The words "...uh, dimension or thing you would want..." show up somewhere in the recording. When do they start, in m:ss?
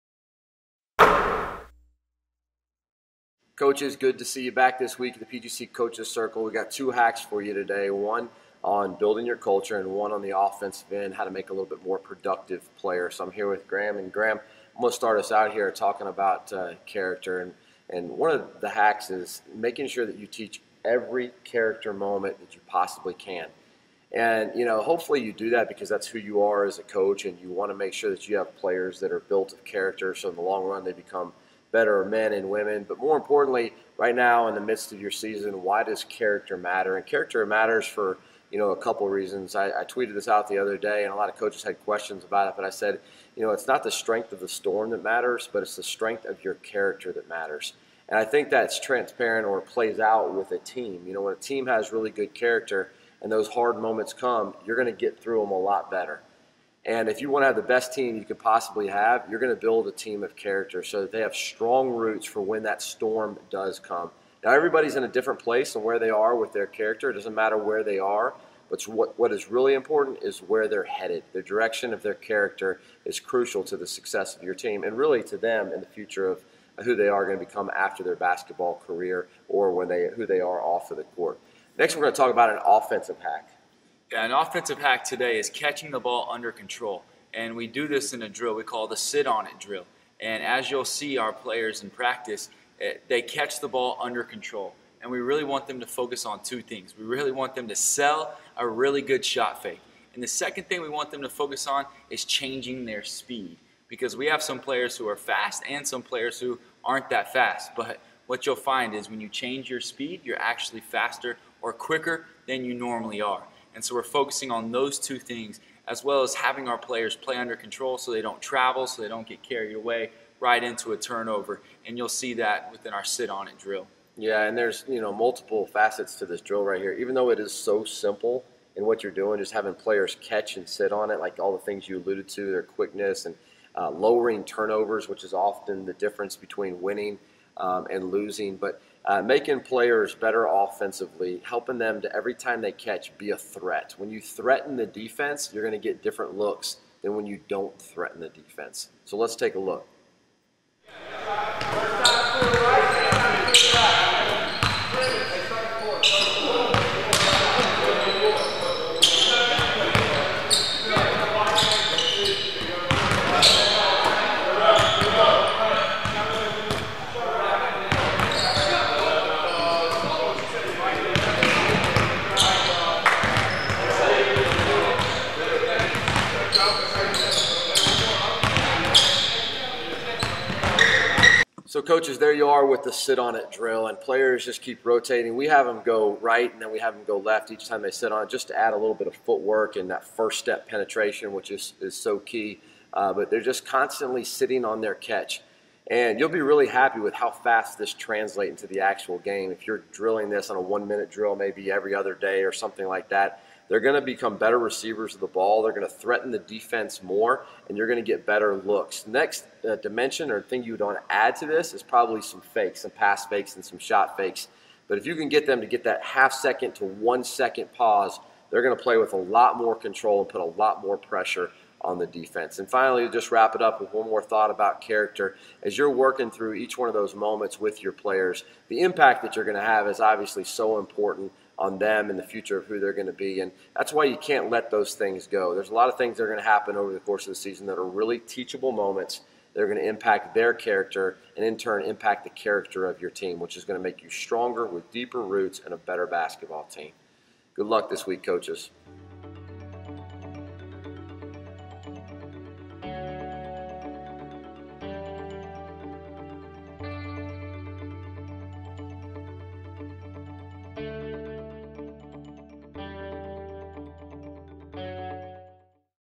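3:29.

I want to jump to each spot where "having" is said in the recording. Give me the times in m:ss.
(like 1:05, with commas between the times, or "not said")
1:56, 2:09.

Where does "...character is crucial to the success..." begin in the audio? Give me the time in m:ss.
1:12.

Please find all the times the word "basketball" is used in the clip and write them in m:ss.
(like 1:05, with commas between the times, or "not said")
1:18, 4:06.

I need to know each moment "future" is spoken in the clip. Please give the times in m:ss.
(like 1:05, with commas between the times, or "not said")
1:15, 3:52.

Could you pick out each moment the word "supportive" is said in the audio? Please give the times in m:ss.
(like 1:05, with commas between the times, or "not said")
not said.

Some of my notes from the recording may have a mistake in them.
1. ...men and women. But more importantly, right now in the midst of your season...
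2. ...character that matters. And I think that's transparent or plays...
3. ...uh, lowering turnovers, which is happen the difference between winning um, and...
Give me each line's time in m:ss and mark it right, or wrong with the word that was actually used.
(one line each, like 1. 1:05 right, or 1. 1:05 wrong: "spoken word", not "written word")
1. 0:32 right
2. 0:46 right
3. 2:13 wrong: "often", not "happen".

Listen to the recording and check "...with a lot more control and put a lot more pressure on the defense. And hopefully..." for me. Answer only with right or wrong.
wrong.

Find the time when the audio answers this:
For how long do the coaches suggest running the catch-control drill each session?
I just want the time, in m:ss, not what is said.
3:20.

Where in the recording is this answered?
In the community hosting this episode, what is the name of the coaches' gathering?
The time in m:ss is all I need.
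0:05.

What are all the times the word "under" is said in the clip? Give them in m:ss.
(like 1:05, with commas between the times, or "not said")
1:26, 1:34, 1:57.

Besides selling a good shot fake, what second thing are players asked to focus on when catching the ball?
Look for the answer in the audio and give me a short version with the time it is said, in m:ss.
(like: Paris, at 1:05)
Changing their speed, at 1:42.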